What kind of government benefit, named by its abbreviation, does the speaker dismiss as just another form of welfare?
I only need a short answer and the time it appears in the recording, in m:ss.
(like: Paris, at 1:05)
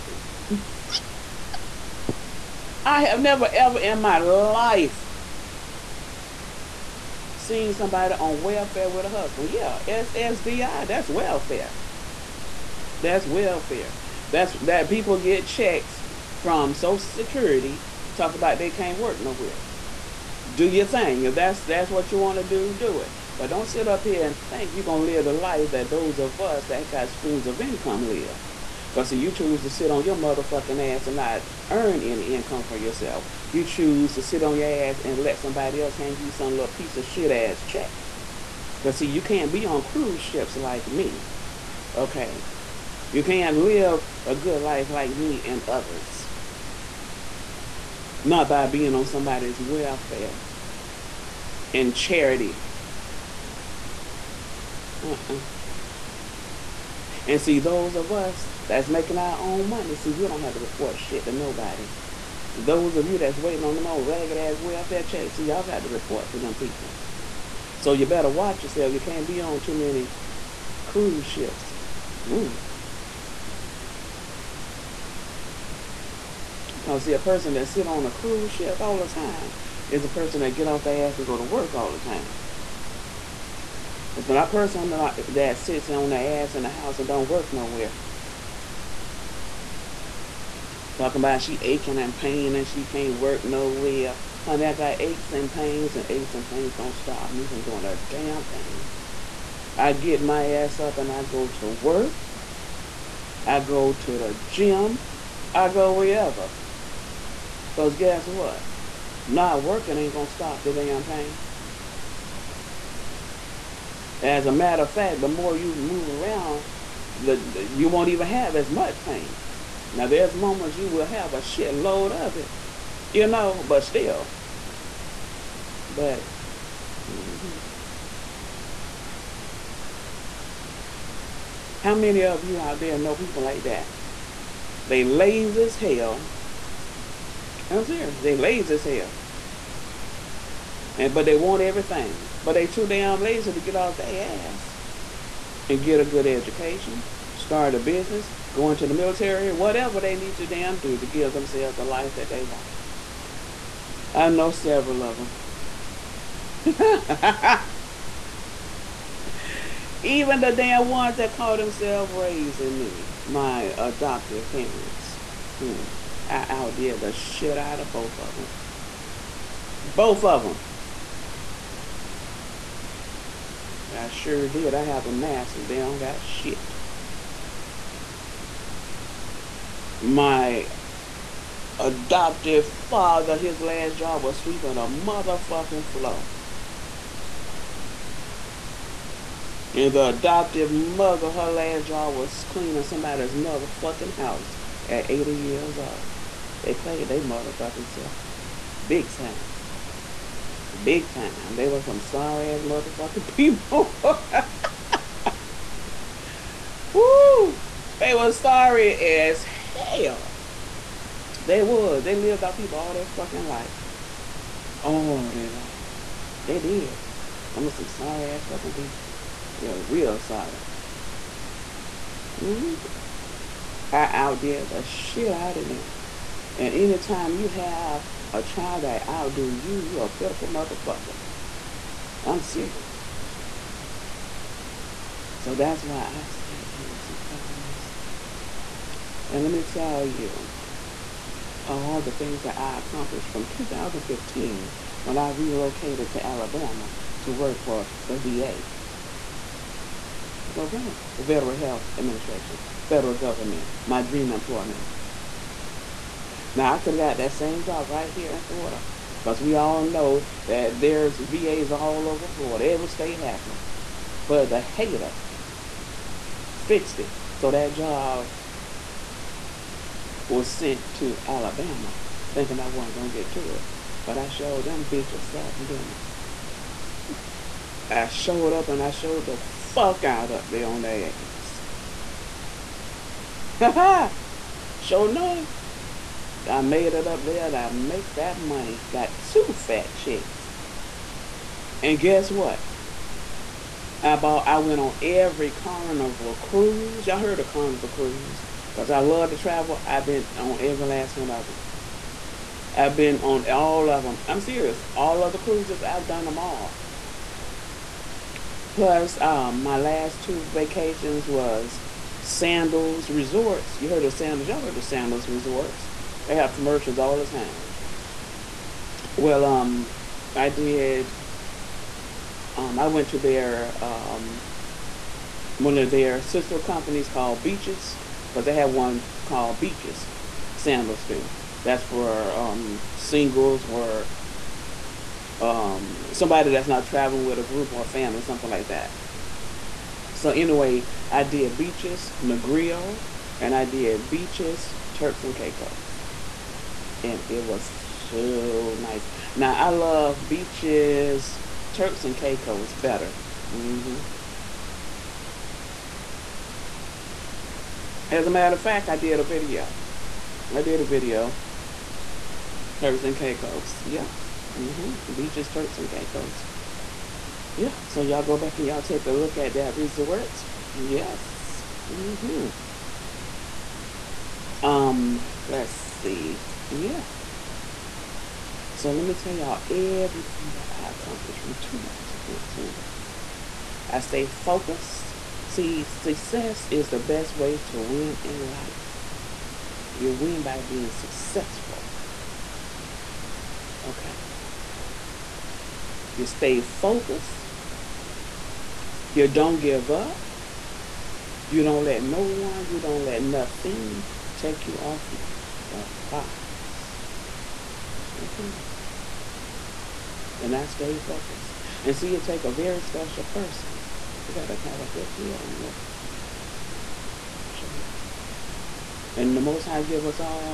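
SSDI, at 0:09.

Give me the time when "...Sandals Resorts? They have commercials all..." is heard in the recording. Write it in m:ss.
5:14.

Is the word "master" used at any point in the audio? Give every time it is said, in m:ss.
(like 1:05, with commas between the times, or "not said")
2:55.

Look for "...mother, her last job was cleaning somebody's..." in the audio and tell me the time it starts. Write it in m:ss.
3:10.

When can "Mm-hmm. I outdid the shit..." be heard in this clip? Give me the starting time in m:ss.
3:42.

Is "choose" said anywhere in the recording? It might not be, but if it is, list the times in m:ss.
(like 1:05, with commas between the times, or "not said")
0:29, 0:33.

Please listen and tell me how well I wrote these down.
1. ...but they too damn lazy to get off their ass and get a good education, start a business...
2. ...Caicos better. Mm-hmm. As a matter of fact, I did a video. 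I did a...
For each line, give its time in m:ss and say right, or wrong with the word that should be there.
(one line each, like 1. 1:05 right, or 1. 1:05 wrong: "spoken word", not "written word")
1. 2:22 right
2. 5:52 right.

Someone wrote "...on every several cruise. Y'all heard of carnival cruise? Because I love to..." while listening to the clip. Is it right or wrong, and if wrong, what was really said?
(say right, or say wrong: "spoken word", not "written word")
wrong: "carnival", not "several".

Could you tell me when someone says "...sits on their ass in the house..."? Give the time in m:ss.
1:25.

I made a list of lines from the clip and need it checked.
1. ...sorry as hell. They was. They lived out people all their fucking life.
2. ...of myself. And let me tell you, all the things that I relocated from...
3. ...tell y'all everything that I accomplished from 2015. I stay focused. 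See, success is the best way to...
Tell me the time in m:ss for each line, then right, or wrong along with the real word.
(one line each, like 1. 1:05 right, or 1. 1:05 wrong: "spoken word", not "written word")
1. 3:28 right
2. 3:57 wrong: "accomplished", not "relocated"
3. 6:19 right.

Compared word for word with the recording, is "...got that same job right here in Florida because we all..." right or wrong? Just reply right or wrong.
right.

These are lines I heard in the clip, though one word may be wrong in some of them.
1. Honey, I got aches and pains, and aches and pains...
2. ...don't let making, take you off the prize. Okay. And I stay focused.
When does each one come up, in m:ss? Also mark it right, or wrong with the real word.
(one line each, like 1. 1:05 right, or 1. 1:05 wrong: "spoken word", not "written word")
1. 1:34 right
2. 6:42 wrong: "nothing", not "making".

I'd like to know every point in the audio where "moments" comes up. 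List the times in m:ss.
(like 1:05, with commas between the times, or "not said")
2:00.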